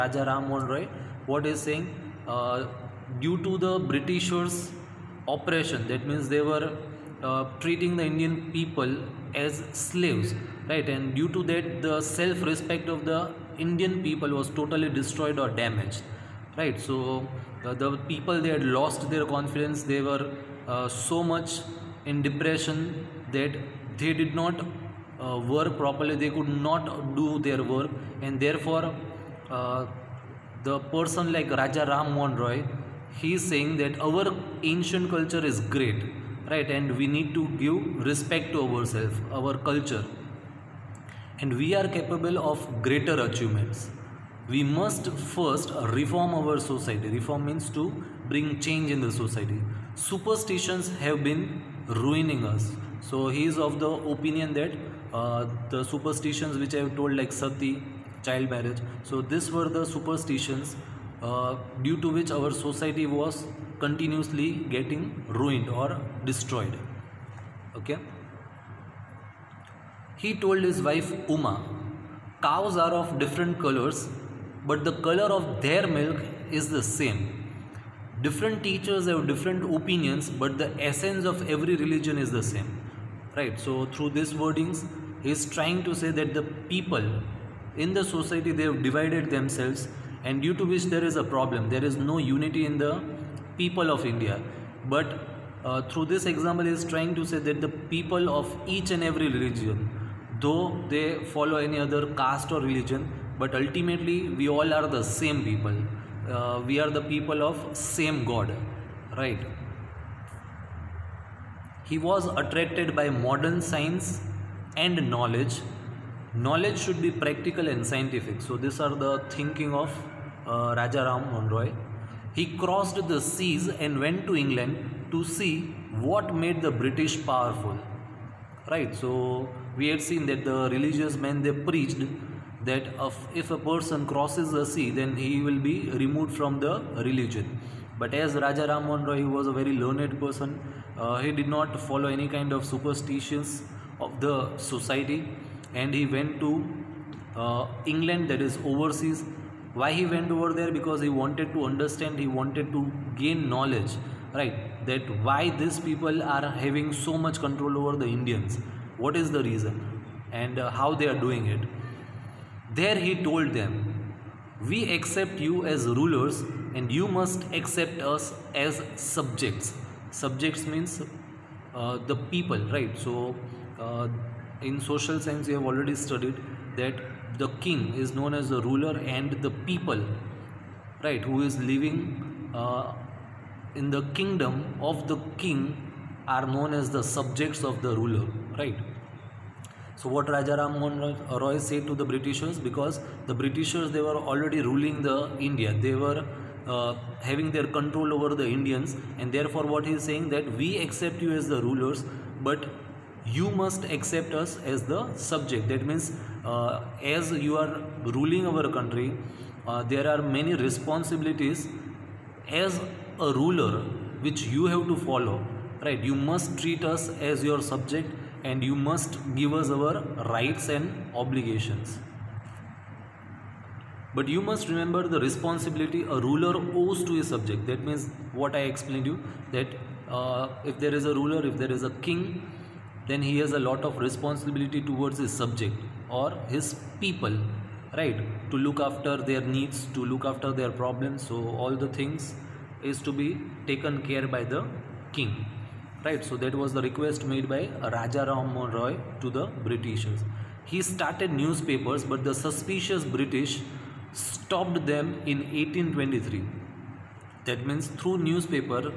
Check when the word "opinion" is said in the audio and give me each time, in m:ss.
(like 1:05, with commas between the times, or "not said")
0:54, 1:19.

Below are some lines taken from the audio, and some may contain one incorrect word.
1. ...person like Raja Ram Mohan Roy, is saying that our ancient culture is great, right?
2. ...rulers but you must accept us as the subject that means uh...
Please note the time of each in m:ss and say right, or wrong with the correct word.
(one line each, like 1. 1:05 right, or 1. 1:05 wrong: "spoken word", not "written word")
1. 0:30 right
2. 3:21 right.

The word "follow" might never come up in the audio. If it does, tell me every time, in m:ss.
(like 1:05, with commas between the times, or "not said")
1:41, 2:21, 3:34.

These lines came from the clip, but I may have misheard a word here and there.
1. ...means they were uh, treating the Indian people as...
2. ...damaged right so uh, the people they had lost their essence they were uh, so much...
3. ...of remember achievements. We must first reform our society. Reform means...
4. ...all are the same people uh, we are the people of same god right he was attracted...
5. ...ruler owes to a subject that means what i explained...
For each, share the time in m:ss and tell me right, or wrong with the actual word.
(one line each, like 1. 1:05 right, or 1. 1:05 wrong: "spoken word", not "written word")
1. 0:06 right
2. 0:15 wrong: "confidence", not "essence"
3. 0:42 wrong: "greater", not "remember"
4. 1:44 right
5. 3:46 right.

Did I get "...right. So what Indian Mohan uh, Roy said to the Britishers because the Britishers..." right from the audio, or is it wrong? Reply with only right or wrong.
wrong.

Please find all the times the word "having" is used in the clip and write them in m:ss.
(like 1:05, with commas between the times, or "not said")
2:36, 3:17.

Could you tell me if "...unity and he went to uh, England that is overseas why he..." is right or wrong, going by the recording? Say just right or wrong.
wrong.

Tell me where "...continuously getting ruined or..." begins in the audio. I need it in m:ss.
1:03.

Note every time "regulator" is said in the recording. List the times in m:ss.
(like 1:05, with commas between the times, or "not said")
not said.